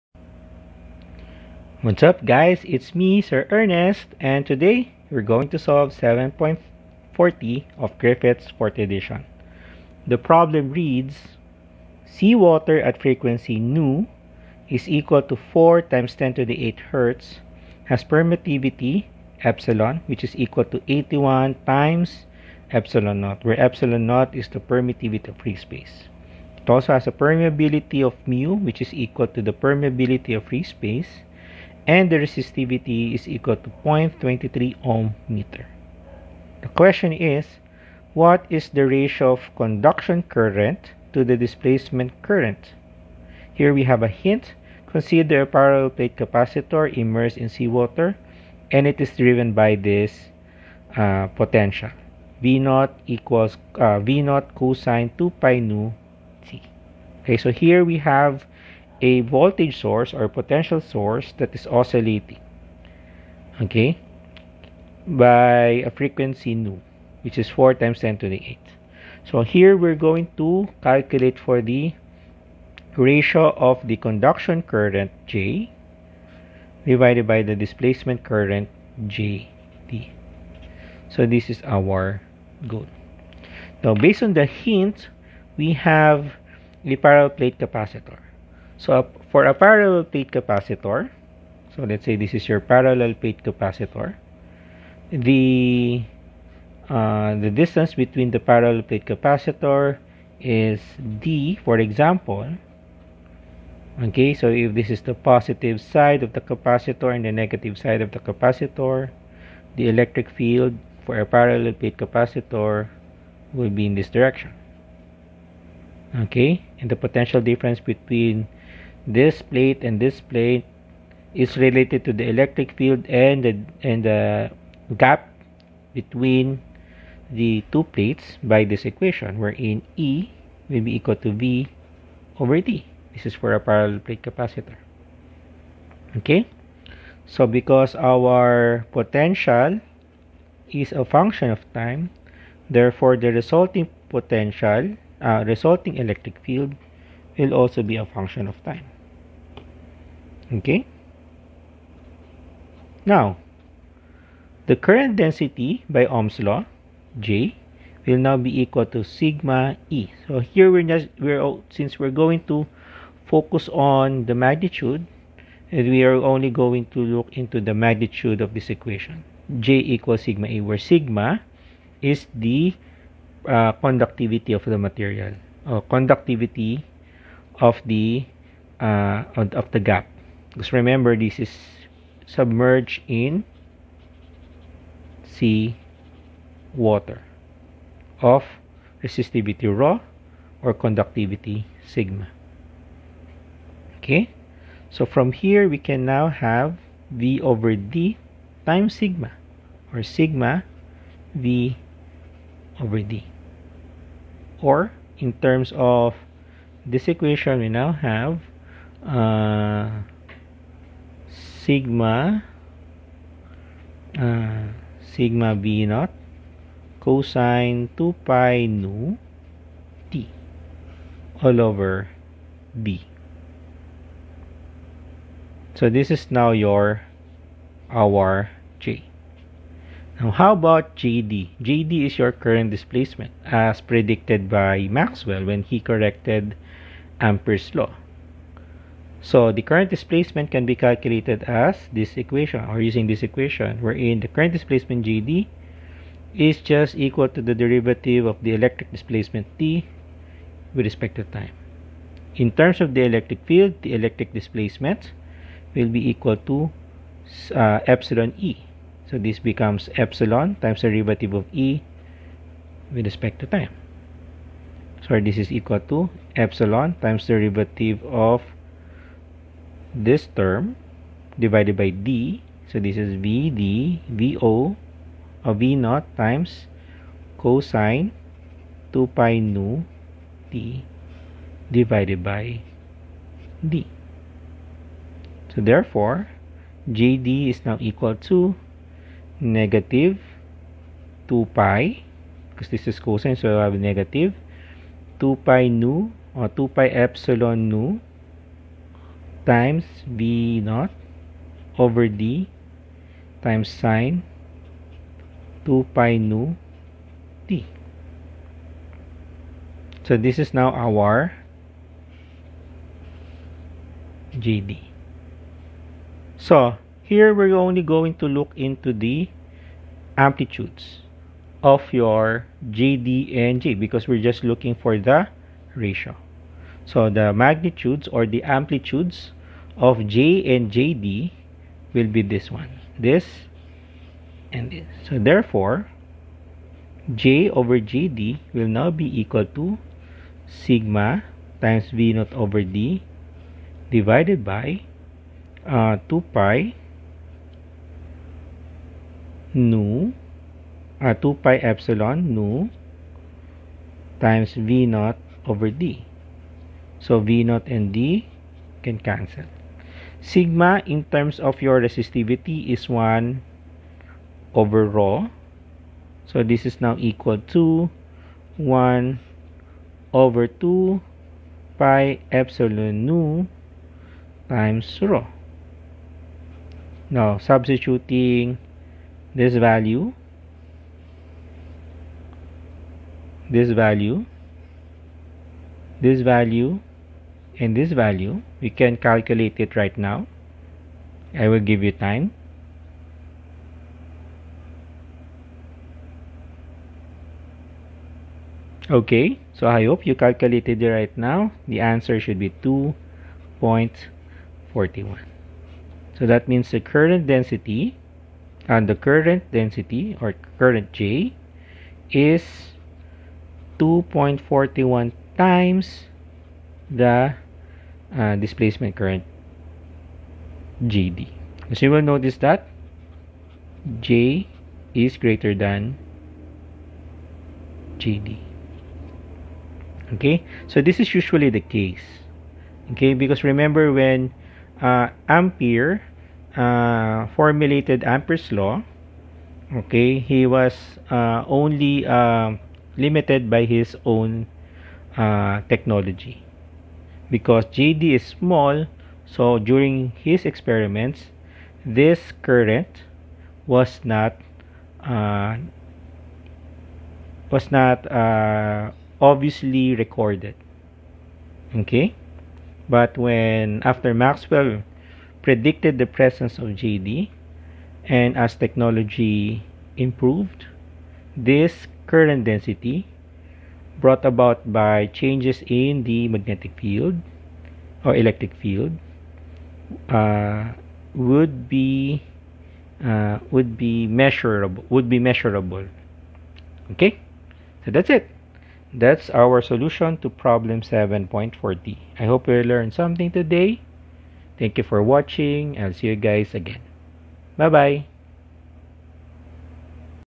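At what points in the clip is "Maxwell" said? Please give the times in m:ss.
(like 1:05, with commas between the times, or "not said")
3:54, 7:44.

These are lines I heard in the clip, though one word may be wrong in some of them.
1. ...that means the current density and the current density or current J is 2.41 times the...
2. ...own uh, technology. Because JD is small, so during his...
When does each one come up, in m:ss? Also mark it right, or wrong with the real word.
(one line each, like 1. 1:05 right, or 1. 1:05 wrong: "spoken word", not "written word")
1. 6:46 right
2. 7:24 right.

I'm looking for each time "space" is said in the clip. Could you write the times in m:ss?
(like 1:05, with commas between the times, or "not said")
0:25, 0:30.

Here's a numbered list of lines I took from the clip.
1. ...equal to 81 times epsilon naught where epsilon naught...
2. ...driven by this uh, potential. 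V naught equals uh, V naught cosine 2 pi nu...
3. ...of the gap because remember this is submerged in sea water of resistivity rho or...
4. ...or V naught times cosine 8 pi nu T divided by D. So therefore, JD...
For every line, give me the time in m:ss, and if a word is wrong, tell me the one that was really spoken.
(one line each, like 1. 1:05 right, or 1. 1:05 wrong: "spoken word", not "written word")
1. 0:20 right
2. 0:49 right
3. 2:59 right
4. 4:35 wrong: "2", not "8".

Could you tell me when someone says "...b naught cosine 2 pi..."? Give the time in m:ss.
3:35.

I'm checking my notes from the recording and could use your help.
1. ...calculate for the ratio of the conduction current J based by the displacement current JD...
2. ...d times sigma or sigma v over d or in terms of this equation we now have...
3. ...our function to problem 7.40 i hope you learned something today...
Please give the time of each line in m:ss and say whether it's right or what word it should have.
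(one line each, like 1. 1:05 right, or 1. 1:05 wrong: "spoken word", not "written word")
1. 1:10 wrong: "divided", not "based"
2. 3:17 right
3. 8:09 wrong: "solution", not "function".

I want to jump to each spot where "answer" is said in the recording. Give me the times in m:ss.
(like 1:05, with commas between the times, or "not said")
6:41.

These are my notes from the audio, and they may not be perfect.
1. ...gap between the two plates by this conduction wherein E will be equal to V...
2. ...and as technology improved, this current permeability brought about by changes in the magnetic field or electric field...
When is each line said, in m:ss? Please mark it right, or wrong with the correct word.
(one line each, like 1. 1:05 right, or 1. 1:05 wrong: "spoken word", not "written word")
1. 2:04 wrong: "equation", not "conduction"
2. 7:48 wrong: "density", not "permeability".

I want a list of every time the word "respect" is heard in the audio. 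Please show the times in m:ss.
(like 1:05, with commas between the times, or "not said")
4:10, 4:23.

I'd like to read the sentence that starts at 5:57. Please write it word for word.
So v naught and d can cancel.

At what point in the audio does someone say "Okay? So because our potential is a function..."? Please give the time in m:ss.
2:16.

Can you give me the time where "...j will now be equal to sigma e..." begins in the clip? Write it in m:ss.
2:37.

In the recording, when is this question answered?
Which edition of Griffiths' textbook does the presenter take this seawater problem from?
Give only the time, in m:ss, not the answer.
0:08.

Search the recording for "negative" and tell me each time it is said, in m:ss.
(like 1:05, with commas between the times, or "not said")
1:47, 4:49, 4:53.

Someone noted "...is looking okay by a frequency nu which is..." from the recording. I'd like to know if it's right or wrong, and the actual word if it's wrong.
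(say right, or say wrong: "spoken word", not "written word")
wrong: "oscillating", not "looking".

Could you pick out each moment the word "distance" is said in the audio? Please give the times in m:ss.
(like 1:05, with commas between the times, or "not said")
1:37.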